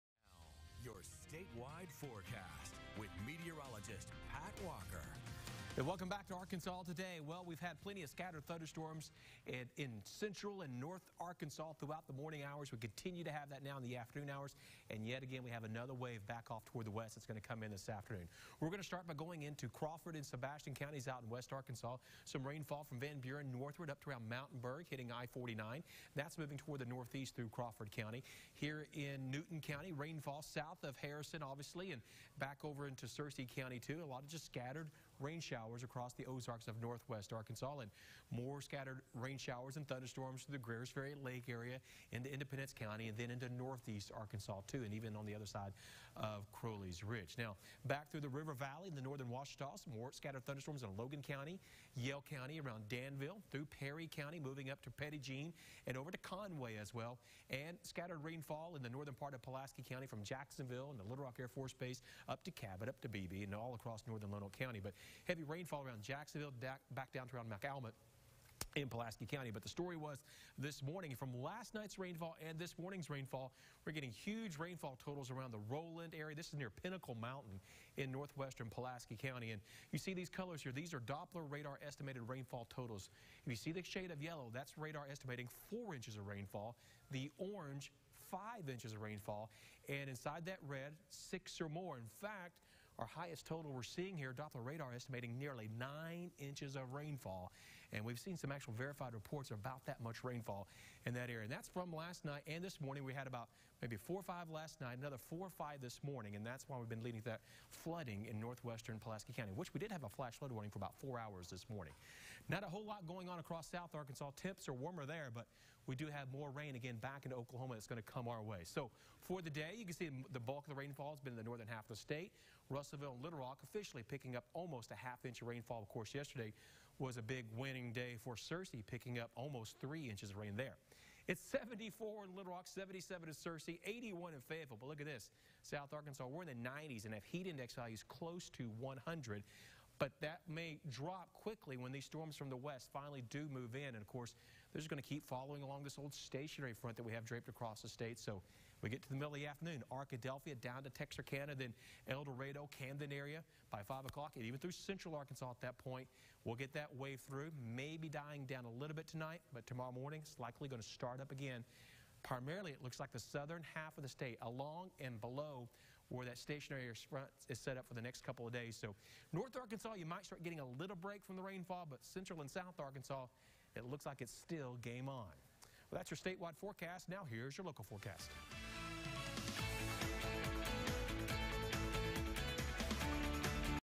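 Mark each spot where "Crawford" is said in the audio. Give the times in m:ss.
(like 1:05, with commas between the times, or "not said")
0:19, 0:27.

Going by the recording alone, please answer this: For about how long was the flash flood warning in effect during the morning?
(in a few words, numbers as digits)
about 4 hours.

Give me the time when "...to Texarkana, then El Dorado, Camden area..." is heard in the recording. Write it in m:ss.
2:30.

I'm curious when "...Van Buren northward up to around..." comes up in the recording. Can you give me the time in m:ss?
0:22.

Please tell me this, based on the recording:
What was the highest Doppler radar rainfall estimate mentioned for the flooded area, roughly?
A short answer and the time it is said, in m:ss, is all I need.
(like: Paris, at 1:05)
nearly 9 inches, at 1:35.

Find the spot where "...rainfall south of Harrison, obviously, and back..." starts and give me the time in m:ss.
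0:29.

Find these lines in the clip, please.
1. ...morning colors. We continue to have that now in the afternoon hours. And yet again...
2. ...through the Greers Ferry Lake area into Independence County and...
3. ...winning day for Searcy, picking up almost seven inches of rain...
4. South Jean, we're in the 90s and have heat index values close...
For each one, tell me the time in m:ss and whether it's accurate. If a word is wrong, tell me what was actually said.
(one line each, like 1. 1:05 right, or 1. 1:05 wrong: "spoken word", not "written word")
1. 0:12 wrong: "hours", not "colors"
2. 0:40 right
3. 2:07 wrong: "three", not "seven"
4. 2:15 wrong: "Arkansas", not "Jean".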